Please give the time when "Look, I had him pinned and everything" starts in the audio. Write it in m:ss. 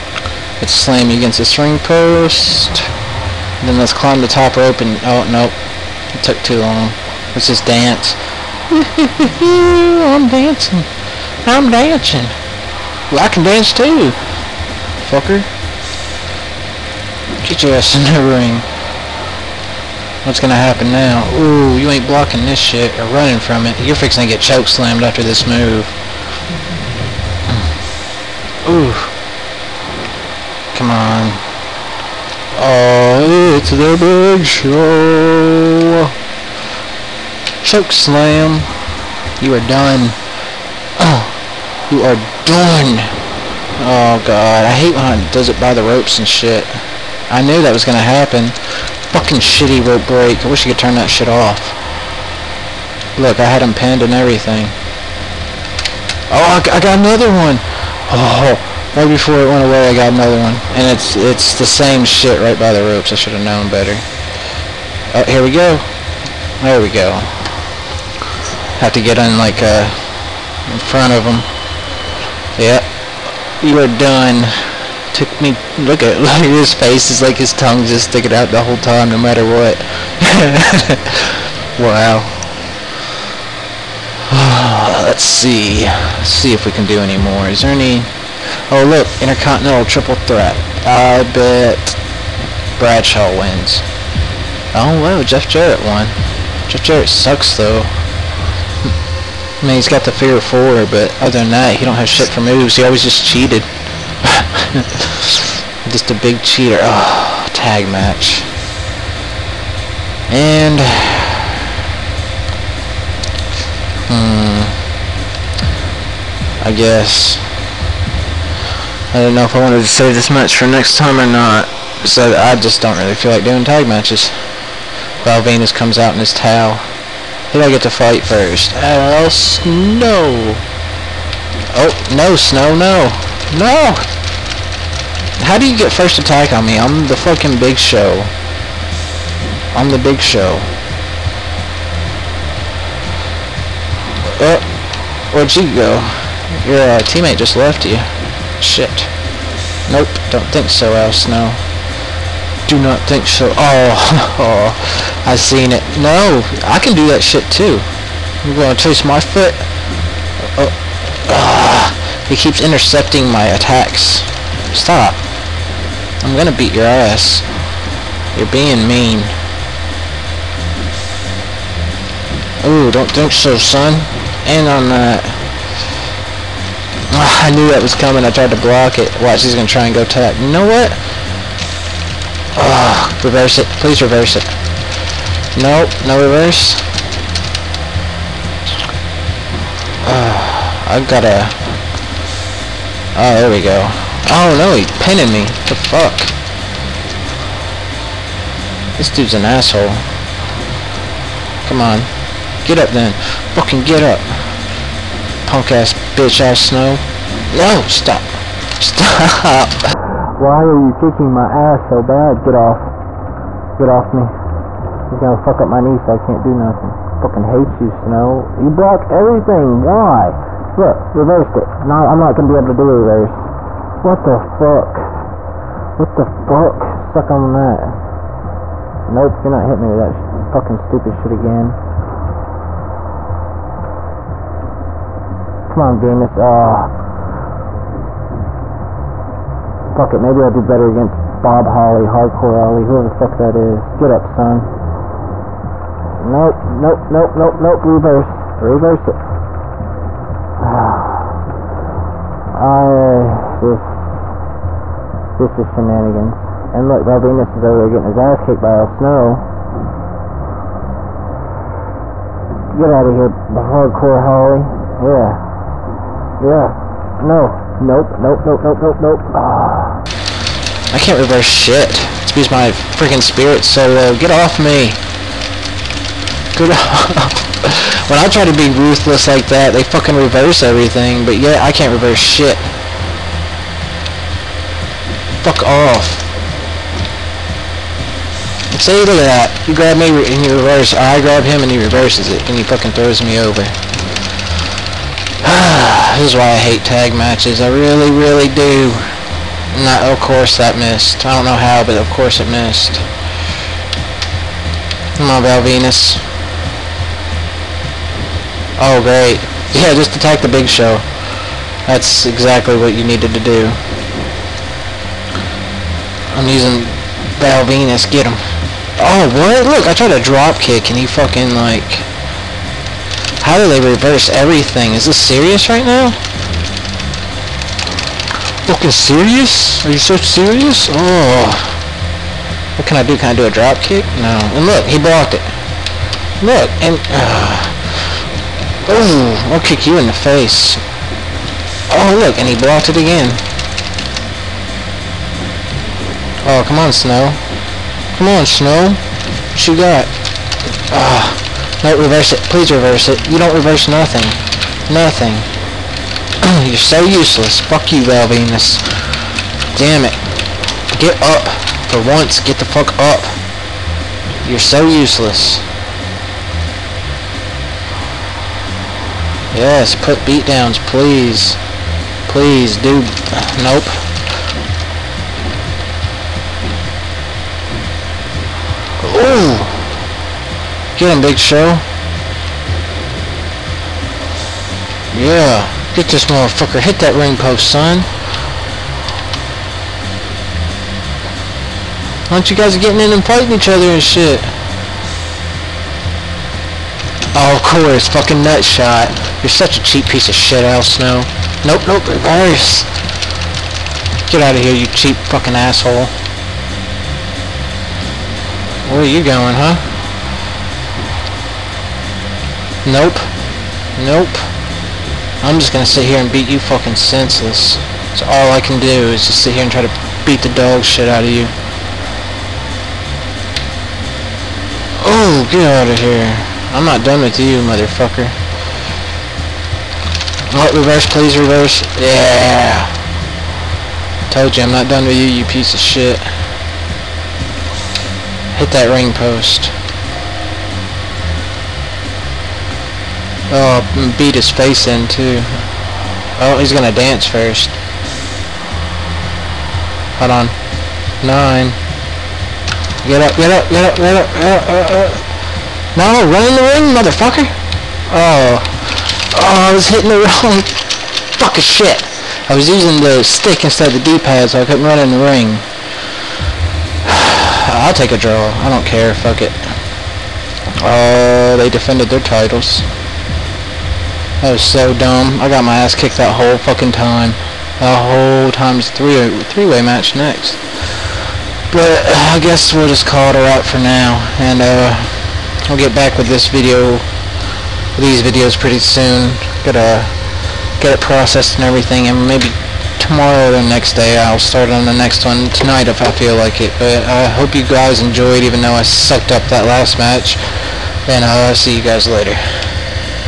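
0:53.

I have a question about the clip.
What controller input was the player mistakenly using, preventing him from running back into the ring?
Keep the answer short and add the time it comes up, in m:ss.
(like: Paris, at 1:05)
the stick, at 7:43.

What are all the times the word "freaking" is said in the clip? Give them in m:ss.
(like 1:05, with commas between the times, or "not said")
4:32.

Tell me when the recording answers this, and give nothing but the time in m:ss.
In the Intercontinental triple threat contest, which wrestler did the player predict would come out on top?
1:32.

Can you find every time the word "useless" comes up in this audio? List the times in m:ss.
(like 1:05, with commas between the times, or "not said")
5:57, 6:04.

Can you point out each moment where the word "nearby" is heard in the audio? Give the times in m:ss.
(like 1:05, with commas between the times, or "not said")
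not said.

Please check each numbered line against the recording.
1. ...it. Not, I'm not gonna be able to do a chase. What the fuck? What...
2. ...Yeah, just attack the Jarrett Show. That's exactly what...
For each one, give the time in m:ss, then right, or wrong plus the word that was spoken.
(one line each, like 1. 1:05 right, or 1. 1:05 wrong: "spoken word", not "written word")
1. 3:41 wrong: "reverse", not "chase"
2. 5:09 wrong: "Big", not "Jarrett".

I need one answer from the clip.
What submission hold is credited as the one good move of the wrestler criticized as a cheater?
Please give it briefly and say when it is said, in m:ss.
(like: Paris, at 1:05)
figure four, at 1:40.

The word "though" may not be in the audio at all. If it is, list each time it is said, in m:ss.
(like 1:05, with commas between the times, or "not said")
1:37, 8:18.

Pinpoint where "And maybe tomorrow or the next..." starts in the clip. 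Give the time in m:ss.
8:12.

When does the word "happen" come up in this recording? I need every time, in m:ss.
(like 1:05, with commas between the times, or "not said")
0:20, 0:47.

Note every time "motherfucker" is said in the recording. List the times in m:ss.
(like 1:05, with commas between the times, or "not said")
6:26, 7:07, 7:36.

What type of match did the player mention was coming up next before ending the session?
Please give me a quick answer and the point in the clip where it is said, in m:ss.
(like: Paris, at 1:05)
three-way match, at 7:59.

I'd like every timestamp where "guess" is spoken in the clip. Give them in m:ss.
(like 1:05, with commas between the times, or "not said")
1:56, 8:02.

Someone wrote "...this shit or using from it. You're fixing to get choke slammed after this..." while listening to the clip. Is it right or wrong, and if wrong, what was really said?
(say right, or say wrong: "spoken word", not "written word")
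wrong: "running", not "using".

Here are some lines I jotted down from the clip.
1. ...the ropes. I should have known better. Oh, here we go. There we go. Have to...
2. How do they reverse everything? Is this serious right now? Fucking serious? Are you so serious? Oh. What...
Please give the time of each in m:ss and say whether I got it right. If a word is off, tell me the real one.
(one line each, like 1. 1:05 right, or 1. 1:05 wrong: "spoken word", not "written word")
1. 1:02 right
2. 5:23 right.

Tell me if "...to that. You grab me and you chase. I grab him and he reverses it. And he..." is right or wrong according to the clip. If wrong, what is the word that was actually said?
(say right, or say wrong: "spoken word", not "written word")
wrong: "reverse", not "chase".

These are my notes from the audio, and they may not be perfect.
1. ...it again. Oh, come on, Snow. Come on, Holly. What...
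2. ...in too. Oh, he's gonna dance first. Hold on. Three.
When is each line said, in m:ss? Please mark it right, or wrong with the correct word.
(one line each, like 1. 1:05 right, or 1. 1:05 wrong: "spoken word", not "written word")
1. 5:42 wrong: "Snow", not "Holly"
2. 7:24 wrong: "Nine", not "Three".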